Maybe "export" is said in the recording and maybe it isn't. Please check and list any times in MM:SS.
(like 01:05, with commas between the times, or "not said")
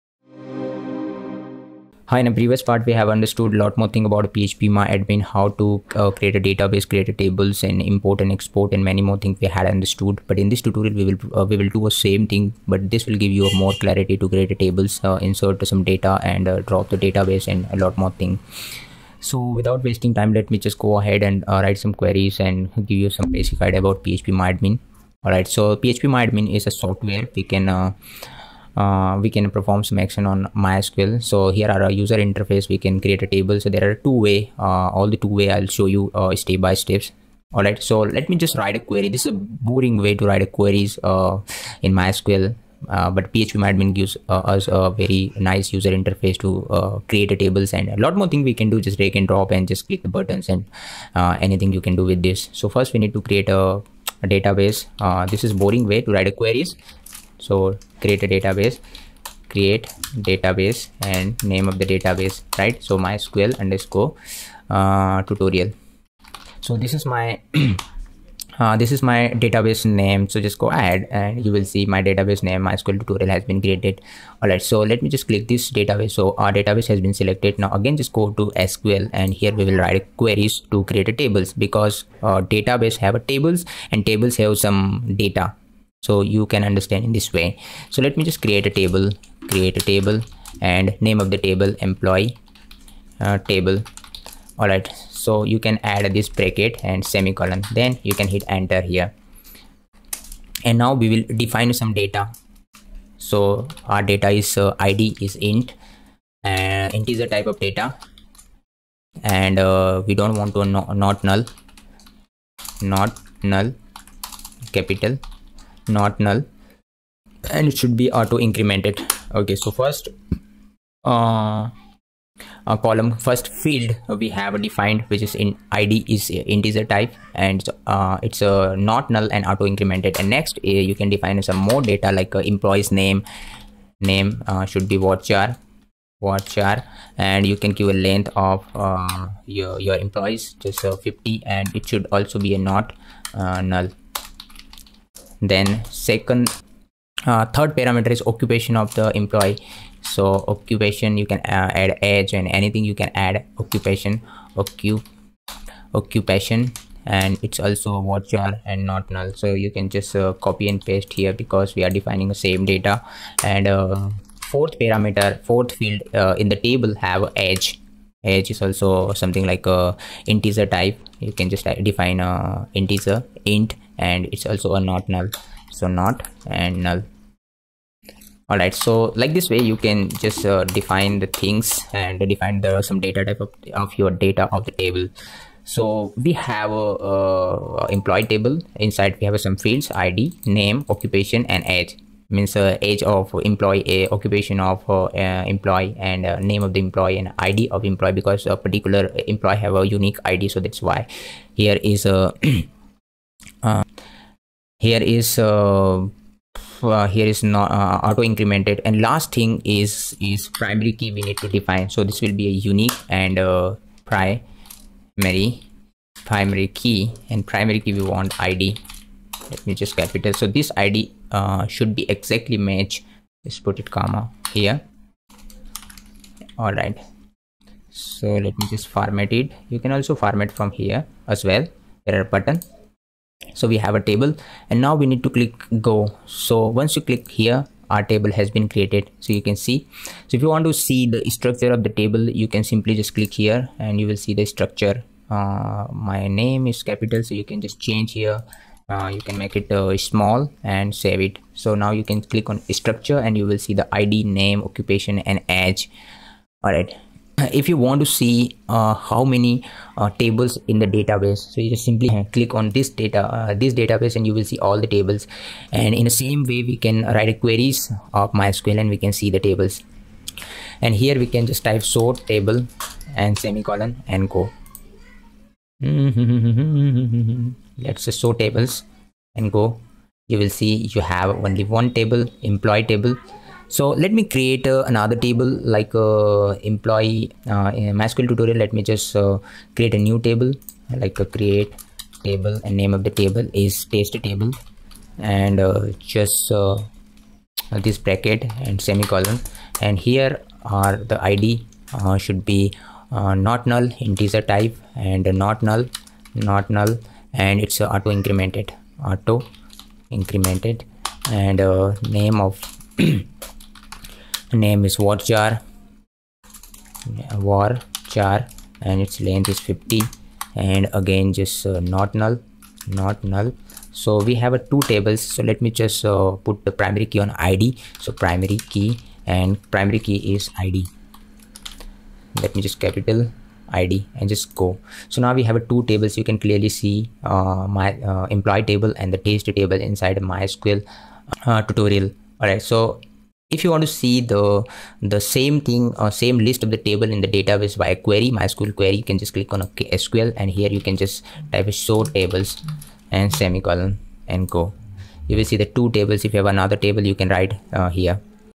00:08.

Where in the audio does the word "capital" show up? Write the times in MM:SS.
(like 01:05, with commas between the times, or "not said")
01:54, 03:39, 04:06, 05:32.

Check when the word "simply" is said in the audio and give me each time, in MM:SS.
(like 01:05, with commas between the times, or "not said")
04:02, 04:21.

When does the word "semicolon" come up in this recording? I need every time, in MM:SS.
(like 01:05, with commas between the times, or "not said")
01:37, 04:33, 04:58, 05:53.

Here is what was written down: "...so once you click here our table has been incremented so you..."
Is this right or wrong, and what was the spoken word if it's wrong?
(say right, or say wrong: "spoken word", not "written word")
wrong: "created", not "incremented".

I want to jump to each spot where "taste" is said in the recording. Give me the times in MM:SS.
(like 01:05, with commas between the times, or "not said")
04:53, 05:39.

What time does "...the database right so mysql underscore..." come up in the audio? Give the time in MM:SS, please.
01:01.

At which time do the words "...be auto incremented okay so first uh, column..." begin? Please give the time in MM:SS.
01:57.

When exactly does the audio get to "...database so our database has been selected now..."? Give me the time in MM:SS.
01:15.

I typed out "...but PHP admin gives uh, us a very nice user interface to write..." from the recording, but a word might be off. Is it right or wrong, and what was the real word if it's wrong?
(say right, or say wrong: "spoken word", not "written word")
wrong: "create", not "write".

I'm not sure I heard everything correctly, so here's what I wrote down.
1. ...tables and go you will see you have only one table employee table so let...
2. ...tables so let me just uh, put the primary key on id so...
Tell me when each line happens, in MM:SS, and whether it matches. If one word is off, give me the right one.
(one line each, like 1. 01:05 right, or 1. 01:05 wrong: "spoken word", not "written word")
1. 04:38 right
2. 05:24 right.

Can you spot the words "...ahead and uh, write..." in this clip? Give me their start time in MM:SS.
00:20.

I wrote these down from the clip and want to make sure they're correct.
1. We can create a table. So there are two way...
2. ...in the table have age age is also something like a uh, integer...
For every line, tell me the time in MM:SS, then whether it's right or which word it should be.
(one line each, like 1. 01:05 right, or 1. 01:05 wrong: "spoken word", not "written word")
1. 00:32 right
2. 02:46 right.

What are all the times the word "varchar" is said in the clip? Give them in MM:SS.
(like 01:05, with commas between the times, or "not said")
02:14, 02:38, 05:14.